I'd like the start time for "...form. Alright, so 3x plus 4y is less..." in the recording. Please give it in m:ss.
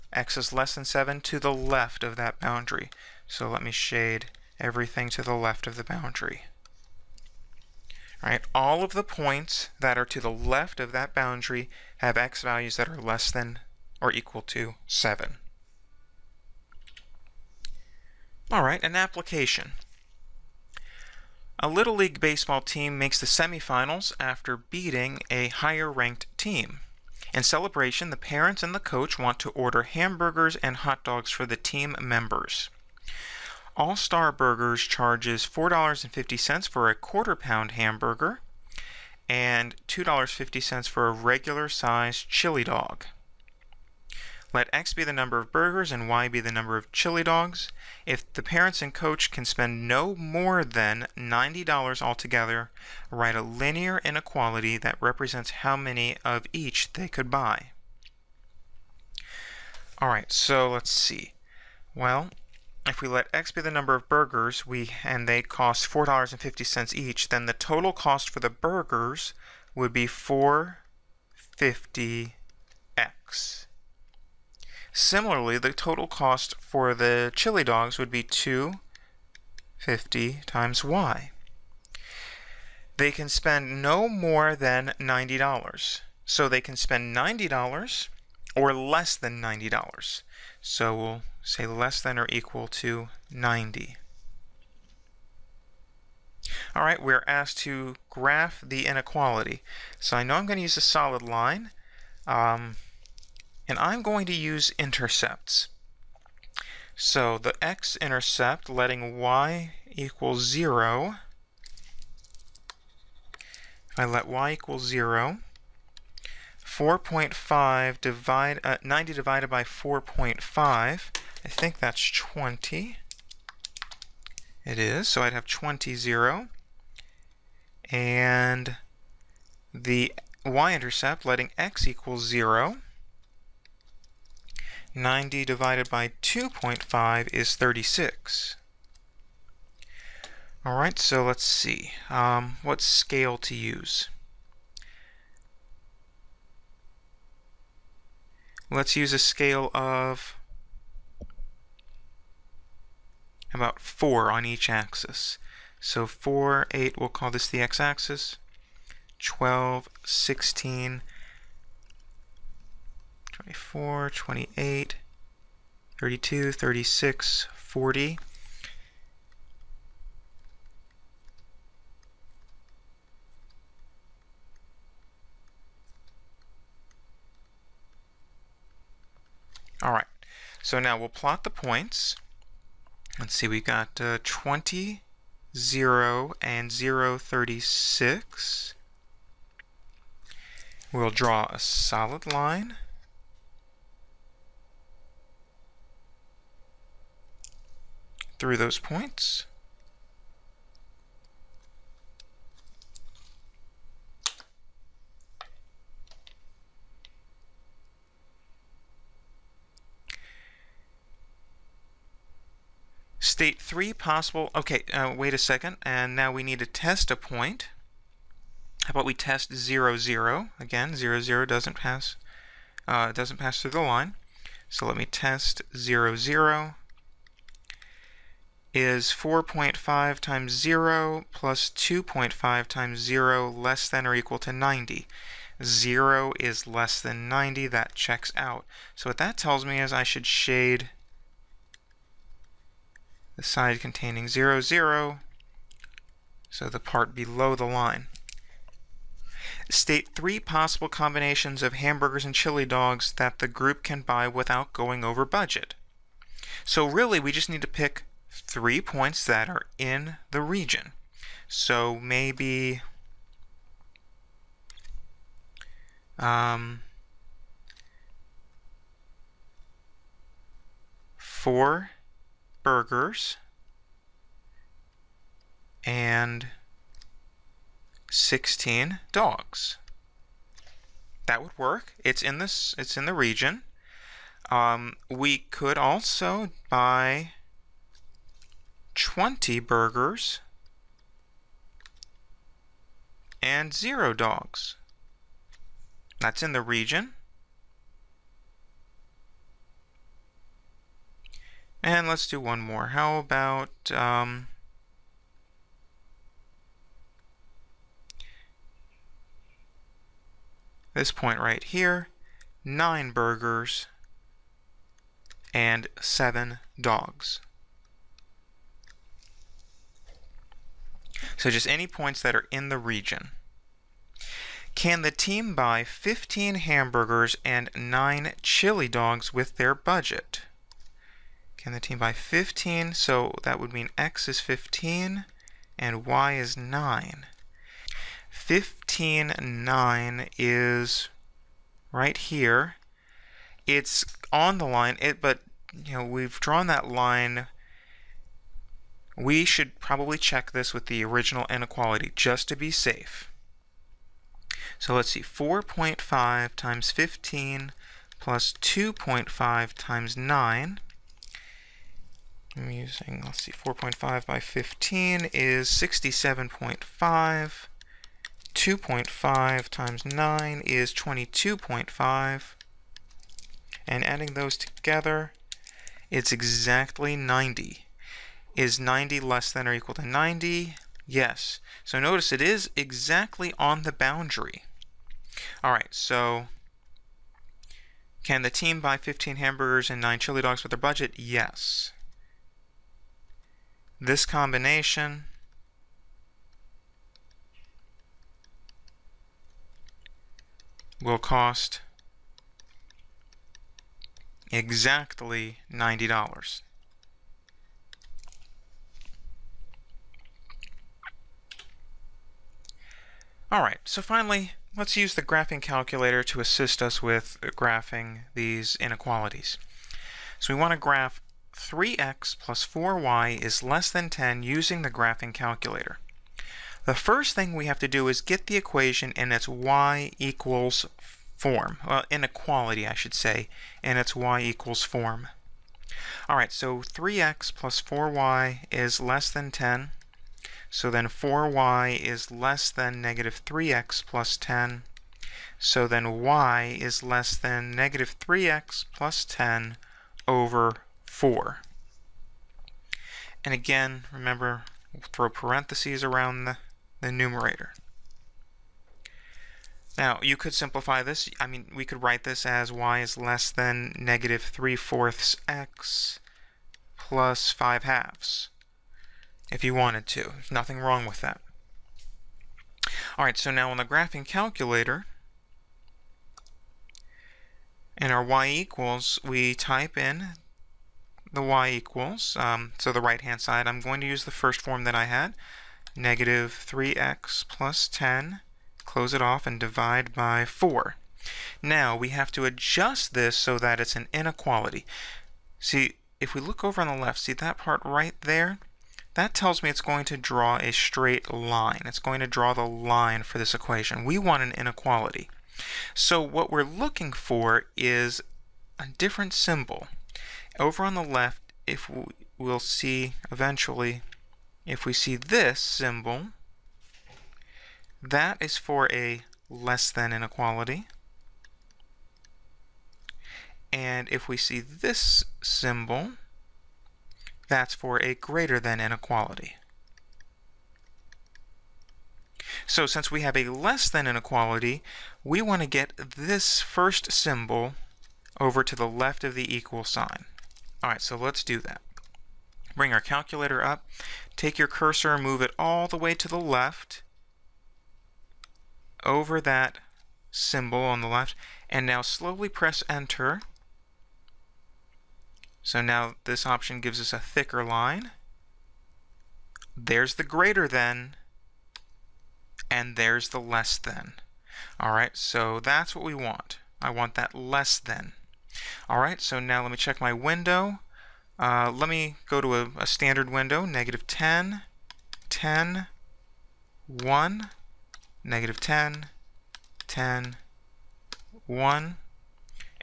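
7:14.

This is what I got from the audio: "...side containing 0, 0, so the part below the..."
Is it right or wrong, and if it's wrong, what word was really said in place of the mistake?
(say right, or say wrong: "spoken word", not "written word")
right.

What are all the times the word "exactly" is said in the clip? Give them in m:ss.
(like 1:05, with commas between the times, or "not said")
6:16, 6:22, 6:44.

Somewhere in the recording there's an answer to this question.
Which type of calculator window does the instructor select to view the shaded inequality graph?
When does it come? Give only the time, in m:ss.
9:32.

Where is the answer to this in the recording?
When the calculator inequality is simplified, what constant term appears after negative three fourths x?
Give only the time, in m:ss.
7:47.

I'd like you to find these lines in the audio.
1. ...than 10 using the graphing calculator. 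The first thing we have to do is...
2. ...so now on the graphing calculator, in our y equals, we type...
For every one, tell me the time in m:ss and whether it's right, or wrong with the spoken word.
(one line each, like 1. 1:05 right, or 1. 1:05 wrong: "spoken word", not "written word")
1. 7:03 right
2. 7:53 right.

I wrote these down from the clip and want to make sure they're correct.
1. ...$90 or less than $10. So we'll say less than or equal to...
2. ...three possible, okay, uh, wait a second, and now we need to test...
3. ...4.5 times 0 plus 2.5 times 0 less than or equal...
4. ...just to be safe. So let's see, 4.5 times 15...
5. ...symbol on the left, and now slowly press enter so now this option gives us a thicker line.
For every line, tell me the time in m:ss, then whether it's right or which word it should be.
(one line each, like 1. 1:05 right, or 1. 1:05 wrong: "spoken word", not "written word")
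1. 1:27 wrong: "90", not "10"
2. 3:33 right
3. 3:49 right
4. 5:52 right
5. 9:10 right.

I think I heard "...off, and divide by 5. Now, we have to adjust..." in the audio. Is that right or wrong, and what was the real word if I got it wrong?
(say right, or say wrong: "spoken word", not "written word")
wrong: "4", not "5".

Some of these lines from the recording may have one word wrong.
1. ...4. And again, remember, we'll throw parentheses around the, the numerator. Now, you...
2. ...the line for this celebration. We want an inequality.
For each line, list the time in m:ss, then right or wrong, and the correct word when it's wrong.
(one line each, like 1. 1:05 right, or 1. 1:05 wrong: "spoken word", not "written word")
1. 7:31 right
2. 8:22 wrong: "equation", not "celebration".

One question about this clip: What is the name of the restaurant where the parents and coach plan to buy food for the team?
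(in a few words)
All Star Burgers.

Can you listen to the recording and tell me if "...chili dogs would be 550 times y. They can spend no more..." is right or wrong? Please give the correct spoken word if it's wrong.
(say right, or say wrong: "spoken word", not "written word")
wrong: "250", not "550".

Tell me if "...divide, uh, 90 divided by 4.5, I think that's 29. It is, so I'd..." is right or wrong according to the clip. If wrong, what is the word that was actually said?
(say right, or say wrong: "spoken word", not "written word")
wrong: "20", not "29".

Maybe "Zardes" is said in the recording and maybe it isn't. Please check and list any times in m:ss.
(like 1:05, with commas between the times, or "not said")
not said.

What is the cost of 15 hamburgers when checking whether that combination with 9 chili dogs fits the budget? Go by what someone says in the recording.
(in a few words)
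67.5.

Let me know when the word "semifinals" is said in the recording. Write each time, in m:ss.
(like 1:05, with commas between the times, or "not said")
0:23.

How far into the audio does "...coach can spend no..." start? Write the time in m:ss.
0:48.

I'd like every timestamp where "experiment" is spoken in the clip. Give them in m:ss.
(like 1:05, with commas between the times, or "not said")
not said.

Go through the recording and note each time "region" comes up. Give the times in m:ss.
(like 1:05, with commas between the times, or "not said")
4:20, 4:43, 4:56, 5:22.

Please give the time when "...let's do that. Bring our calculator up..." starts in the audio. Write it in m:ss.
9:01.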